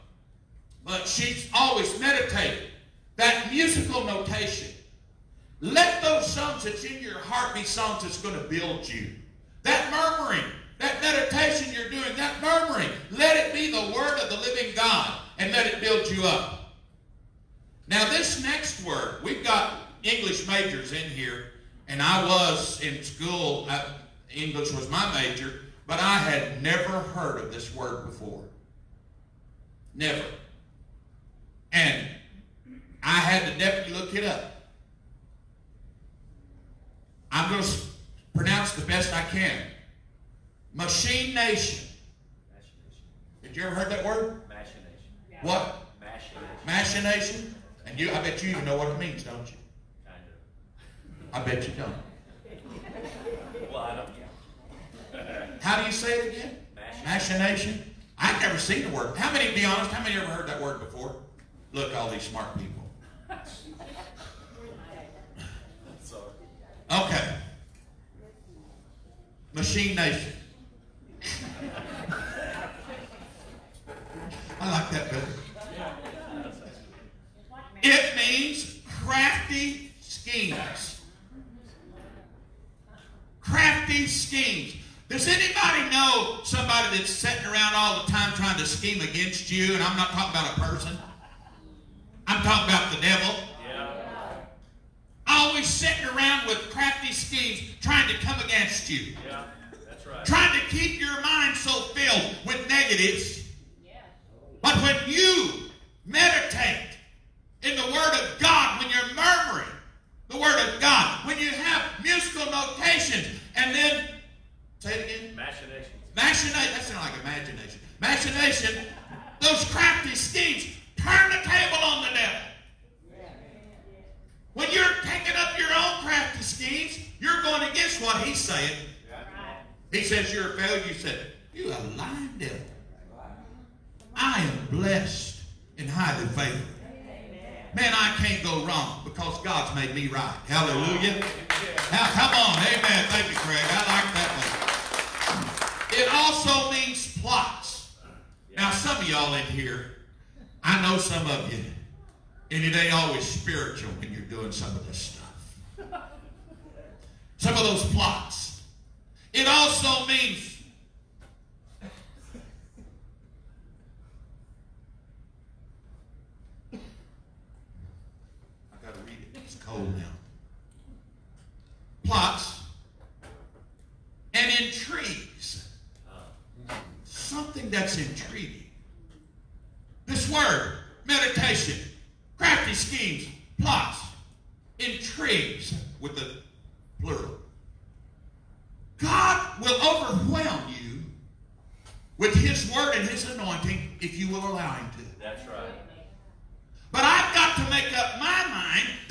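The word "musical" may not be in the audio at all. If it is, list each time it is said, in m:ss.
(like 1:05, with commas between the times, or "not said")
0:03, 1:52.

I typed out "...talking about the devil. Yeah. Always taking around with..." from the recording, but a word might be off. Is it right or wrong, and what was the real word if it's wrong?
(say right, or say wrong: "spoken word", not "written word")
wrong: "sitting", not "taking".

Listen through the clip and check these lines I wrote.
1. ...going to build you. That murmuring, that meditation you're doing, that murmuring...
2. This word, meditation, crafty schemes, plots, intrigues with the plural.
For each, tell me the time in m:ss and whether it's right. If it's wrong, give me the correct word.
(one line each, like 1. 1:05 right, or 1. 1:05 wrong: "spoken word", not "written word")
1. 0:08 right
2. 3:00 right.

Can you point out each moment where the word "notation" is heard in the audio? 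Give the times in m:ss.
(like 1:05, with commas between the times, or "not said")
0:04, 1:52.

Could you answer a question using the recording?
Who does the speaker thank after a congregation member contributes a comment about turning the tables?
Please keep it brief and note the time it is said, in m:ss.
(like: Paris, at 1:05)
Craig, at 2:23.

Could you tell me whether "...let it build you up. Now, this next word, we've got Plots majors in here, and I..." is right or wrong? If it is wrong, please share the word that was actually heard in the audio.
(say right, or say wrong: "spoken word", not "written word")
wrong: "English", not "Plots".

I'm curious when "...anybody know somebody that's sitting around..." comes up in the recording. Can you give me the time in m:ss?
1:25.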